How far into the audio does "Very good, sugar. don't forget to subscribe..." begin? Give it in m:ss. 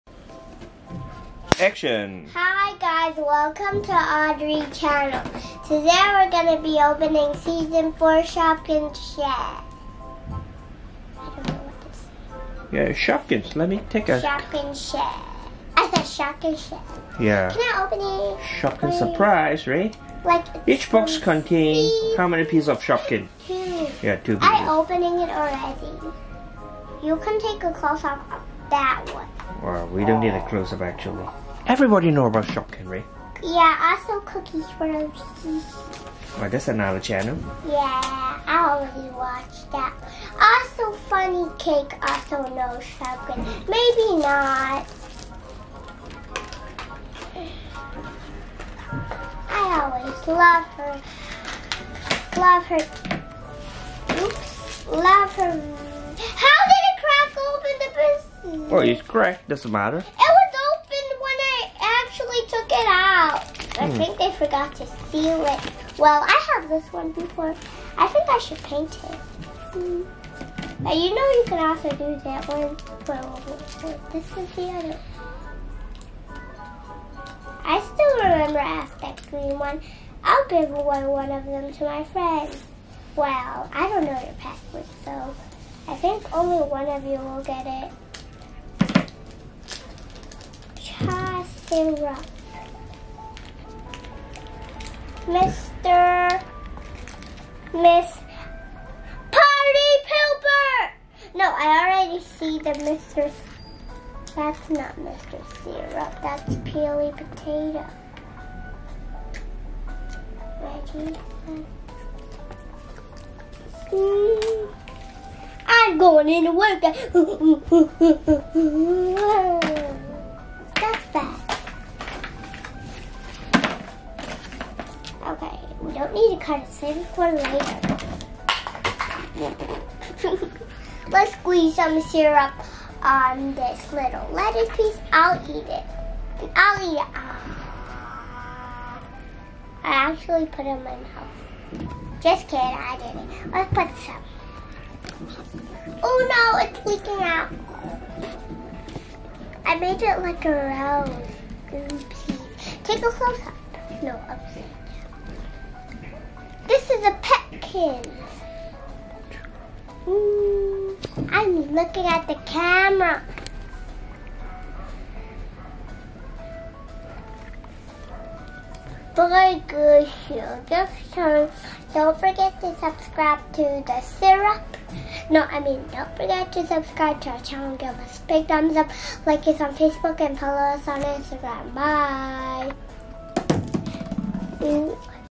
2:49.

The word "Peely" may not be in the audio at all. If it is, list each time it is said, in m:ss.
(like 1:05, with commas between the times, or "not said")
1:46.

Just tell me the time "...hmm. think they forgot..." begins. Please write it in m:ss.
1:03.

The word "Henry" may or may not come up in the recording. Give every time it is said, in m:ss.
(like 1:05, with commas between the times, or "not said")
0:32, 0:42.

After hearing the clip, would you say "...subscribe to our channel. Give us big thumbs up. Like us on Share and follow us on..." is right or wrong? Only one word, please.
wrong.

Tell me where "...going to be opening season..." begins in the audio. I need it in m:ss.
0:06.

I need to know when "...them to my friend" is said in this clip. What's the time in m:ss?
1:21.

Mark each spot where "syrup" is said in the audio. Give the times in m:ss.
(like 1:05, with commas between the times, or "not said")
1:45, 2:12, 2:54.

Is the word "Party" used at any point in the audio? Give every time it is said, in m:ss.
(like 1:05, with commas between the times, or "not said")
1:39.